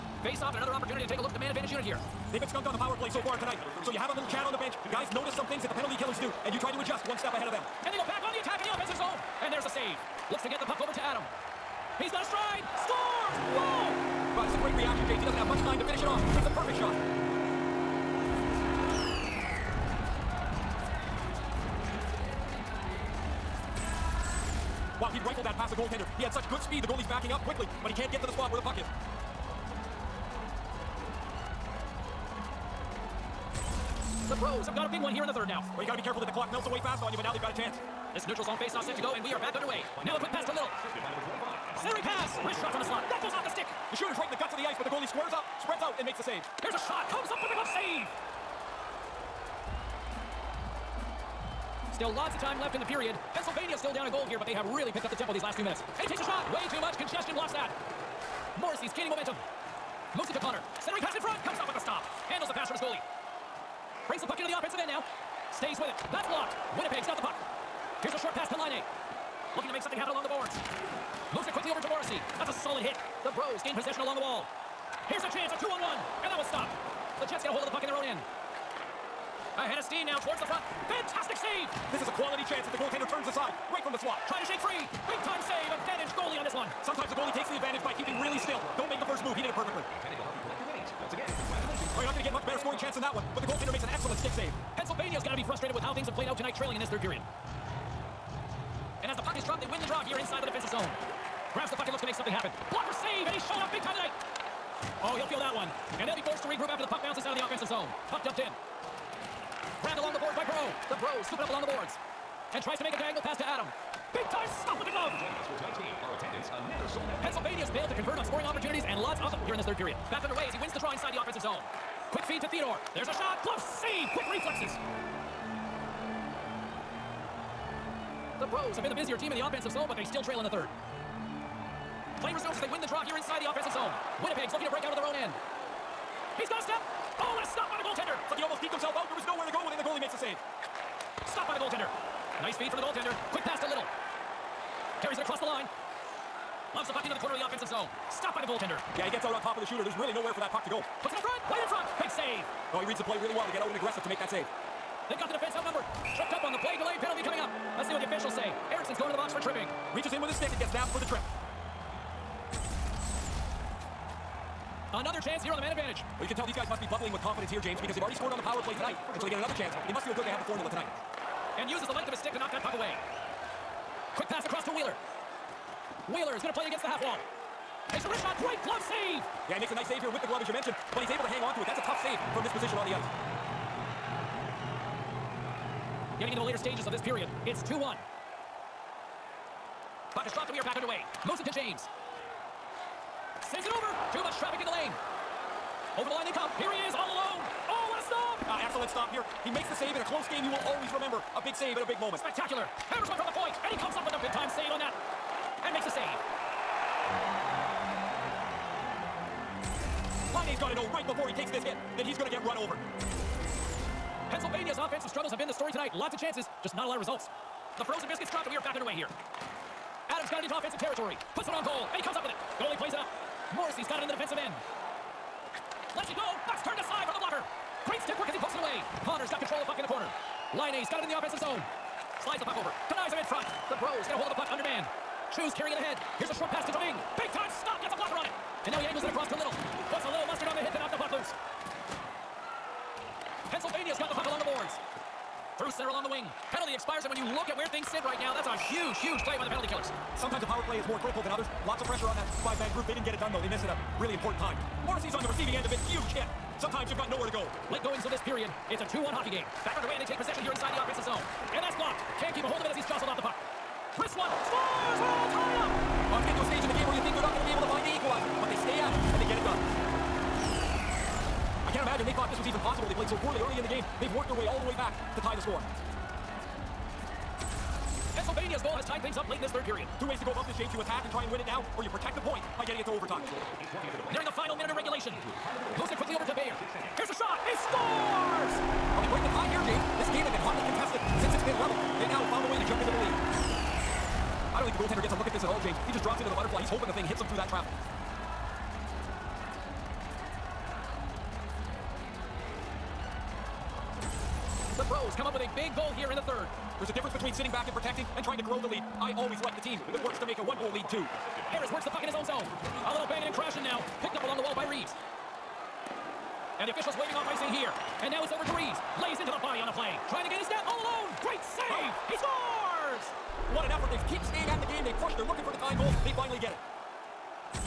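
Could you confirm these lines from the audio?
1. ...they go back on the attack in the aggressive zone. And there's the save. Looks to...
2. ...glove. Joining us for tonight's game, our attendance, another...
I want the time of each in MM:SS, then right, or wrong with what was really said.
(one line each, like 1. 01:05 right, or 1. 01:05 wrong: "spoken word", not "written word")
1. 00:07 wrong: "offensive", not "aggressive"
2. 01:54 right.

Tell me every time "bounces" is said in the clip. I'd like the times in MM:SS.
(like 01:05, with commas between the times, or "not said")
01:47.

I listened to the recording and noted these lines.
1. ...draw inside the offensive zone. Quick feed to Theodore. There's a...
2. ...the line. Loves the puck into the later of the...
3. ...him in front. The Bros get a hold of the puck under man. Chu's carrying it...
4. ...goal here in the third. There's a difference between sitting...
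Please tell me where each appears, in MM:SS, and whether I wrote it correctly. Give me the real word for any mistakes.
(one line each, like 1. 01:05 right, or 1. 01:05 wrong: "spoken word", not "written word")
1. 02:00 right
2. 02:25 wrong: "corner", not "later"
3. 03:53 right
4. 05:05 right.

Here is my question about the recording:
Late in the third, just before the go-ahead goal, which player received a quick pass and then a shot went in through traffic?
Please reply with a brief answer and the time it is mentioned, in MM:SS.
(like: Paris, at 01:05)
Bayer, at 04:46.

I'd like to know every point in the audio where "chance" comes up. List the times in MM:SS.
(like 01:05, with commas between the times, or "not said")
00:37, 01:15, 01:22, 01:32, 02:45, 02:49, 03:36.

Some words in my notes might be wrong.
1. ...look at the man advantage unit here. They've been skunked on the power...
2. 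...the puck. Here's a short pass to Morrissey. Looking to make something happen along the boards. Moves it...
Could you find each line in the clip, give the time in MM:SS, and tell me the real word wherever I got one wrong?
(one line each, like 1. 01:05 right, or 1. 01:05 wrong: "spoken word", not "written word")
1. 00:01 right
2. 01:07 wrong: "Laine", not "Morrissey".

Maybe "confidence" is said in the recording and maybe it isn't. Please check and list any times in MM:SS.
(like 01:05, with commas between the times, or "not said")
02:47.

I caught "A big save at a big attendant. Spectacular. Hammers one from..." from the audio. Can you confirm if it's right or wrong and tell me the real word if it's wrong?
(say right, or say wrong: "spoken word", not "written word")
wrong: "moment", not "attendant".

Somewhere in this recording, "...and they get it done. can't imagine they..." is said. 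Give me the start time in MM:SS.
04:29.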